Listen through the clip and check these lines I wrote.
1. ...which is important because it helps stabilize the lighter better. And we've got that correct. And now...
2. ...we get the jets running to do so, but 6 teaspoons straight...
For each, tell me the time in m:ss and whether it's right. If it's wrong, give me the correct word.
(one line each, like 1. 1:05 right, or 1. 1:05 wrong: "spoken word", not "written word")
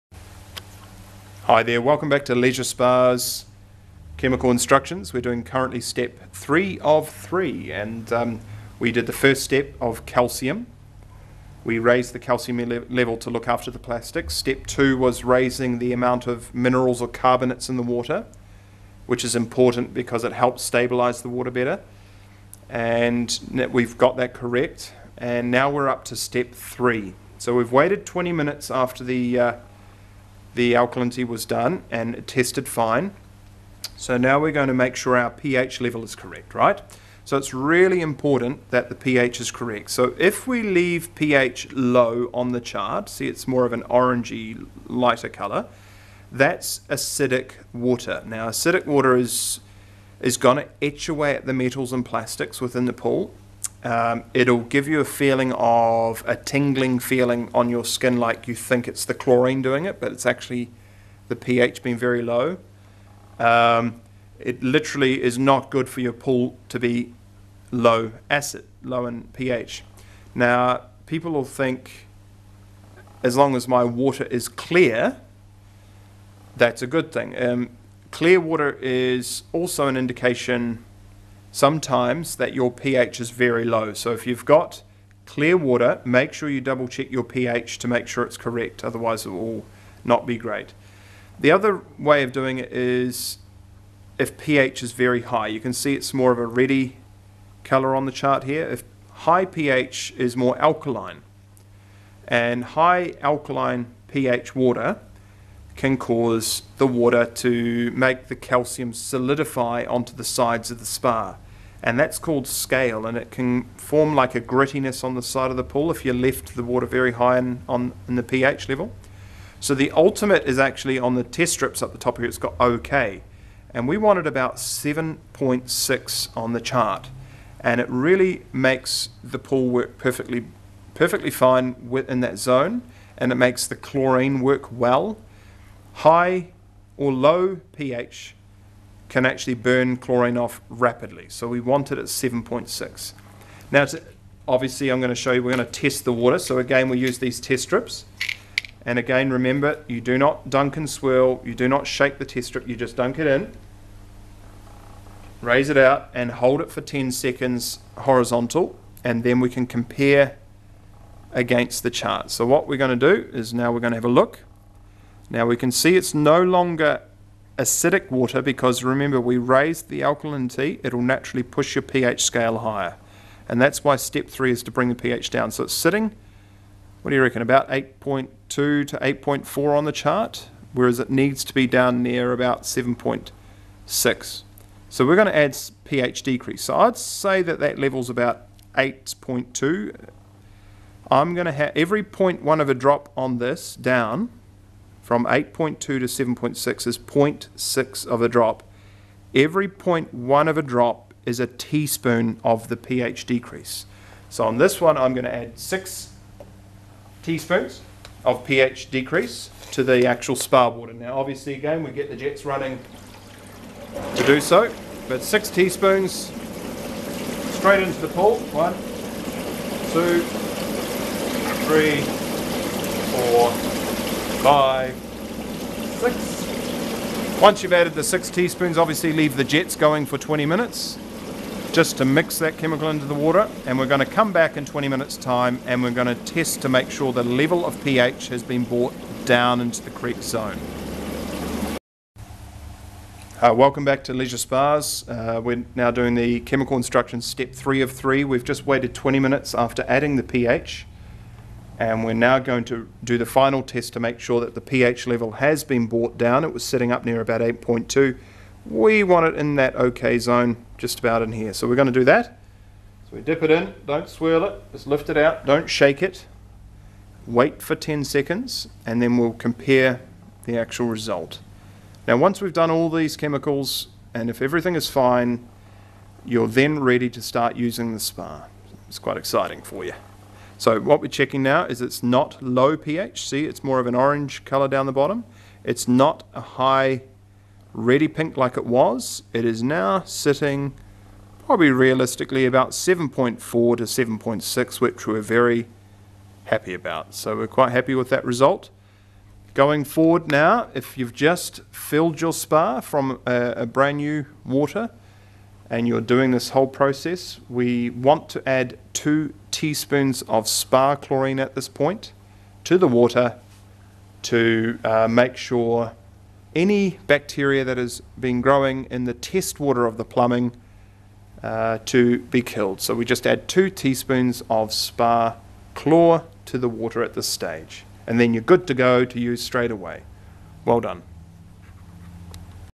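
1. 0:19 wrong: "water", not "lighter"
2. 3:31 right.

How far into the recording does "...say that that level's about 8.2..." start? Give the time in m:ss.
3:06.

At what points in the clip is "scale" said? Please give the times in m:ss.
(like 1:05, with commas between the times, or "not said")
1:52, 2:52.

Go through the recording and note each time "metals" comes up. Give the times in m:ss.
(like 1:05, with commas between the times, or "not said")
0:51.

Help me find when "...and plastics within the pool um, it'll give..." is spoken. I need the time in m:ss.
0:51.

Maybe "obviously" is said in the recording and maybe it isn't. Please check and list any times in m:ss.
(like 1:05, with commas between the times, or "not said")
2:24, 3:31, 3:48.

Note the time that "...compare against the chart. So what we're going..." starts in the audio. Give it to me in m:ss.
2:39.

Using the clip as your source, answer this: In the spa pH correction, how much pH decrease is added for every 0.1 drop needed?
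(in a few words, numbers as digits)
a teaspoon.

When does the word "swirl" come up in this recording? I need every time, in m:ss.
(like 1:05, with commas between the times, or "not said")
2:30, 4:24.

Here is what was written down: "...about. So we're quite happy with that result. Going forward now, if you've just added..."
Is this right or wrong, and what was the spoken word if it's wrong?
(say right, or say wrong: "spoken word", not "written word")
wrong: "filled", not "added".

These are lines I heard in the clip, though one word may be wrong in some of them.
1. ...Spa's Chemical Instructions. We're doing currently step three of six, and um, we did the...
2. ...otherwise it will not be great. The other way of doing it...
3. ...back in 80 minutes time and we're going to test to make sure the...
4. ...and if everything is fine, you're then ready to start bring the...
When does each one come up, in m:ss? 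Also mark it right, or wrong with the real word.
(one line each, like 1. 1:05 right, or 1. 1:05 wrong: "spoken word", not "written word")
1. 0:02 wrong: "three", not "six"
2. 1:28 right
3. 3:54 wrong: "20", not "80"
4. 4:34 wrong: "using", not "bring".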